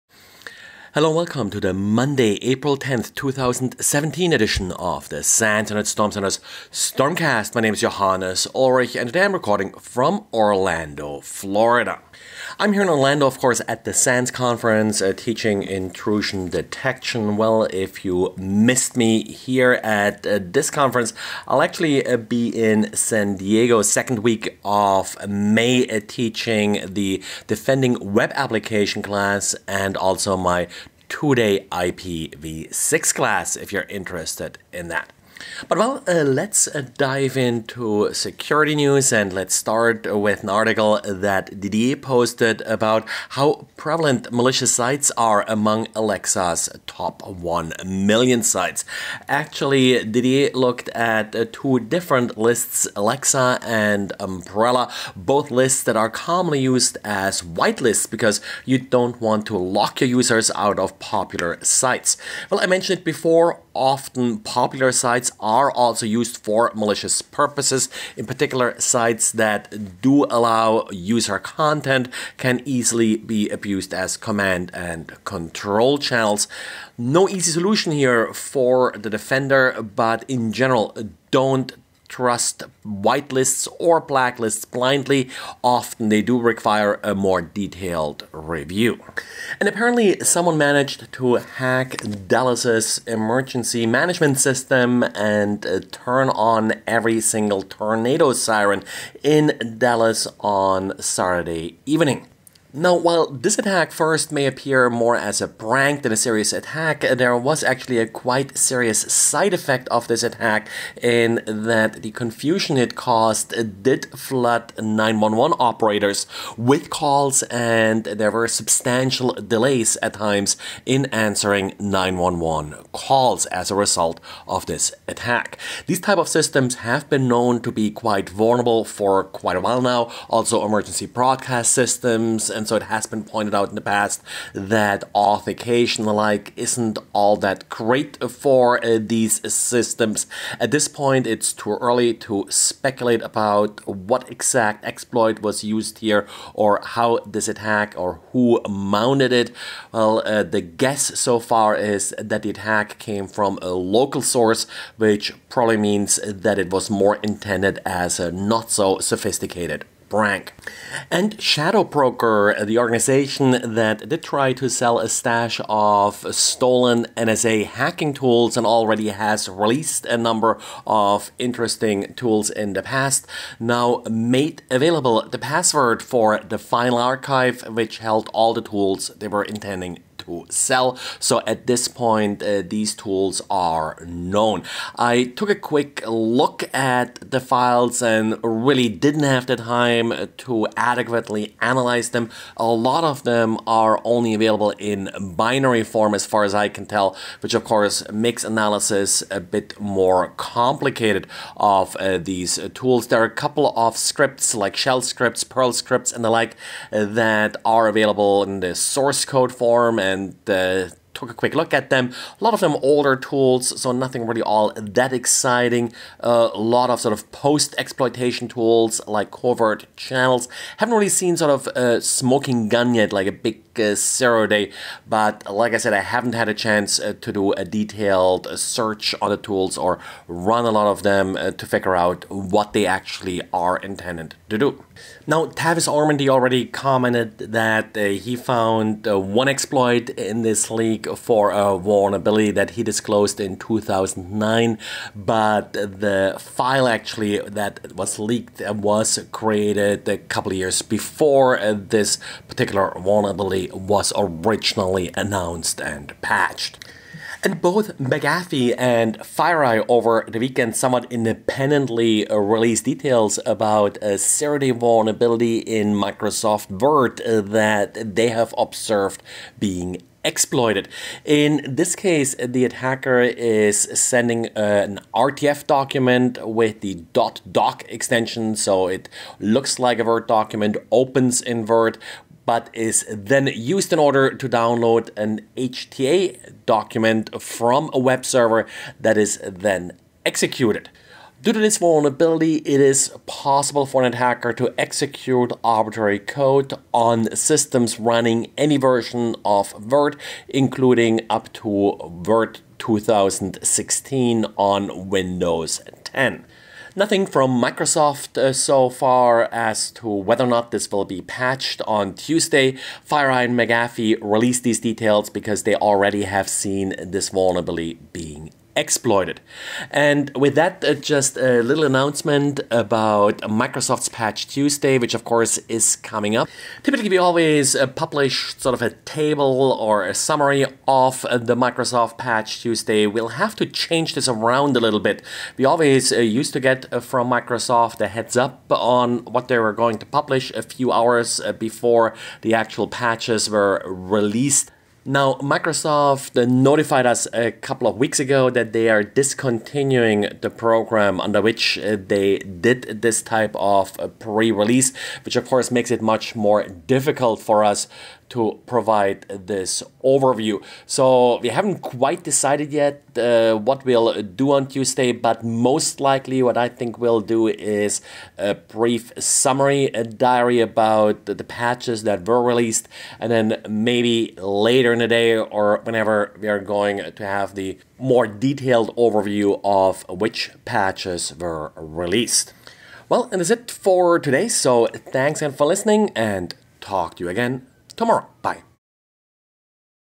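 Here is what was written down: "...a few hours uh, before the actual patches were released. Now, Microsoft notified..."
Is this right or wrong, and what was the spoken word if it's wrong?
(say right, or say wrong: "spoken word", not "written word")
right.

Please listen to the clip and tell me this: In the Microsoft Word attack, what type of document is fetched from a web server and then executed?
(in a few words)
HTA.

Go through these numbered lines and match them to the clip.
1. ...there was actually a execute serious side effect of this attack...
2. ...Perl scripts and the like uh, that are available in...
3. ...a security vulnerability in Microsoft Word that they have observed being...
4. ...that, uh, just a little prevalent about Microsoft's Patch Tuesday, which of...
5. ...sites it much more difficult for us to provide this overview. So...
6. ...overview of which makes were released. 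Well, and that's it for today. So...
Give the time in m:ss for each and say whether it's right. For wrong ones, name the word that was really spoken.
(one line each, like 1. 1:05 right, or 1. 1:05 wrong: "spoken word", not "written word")
1. 1:47 wrong: "quite", not "execute"
2. 3:25 right
3. 4:24 right
4. 5:20 wrong: "announcement", not "prevalent"
5. 5:55 wrong: "makes", not "sites"
6. 6:18 wrong: "patches", not "makes".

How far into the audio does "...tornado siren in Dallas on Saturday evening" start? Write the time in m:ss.
1:37.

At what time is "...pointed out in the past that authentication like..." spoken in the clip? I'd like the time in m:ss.
2:13.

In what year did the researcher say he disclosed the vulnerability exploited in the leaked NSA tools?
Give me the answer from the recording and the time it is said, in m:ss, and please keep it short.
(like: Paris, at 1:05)
2009, at 4:03.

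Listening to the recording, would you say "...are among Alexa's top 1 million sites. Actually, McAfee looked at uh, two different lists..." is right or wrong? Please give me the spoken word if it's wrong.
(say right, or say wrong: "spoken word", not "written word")
wrong: "Didier", not "McAfee".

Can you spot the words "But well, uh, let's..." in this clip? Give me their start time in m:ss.
0:35.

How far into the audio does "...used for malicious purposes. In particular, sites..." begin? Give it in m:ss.
1:06.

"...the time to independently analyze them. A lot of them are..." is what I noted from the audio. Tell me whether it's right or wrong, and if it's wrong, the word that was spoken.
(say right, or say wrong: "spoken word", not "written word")
wrong: "adequately", not "independently".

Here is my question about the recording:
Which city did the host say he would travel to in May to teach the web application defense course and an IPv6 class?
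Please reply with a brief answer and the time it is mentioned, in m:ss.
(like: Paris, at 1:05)
San Diego, at 0:22.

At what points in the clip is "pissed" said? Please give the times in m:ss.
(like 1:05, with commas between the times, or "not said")
not said.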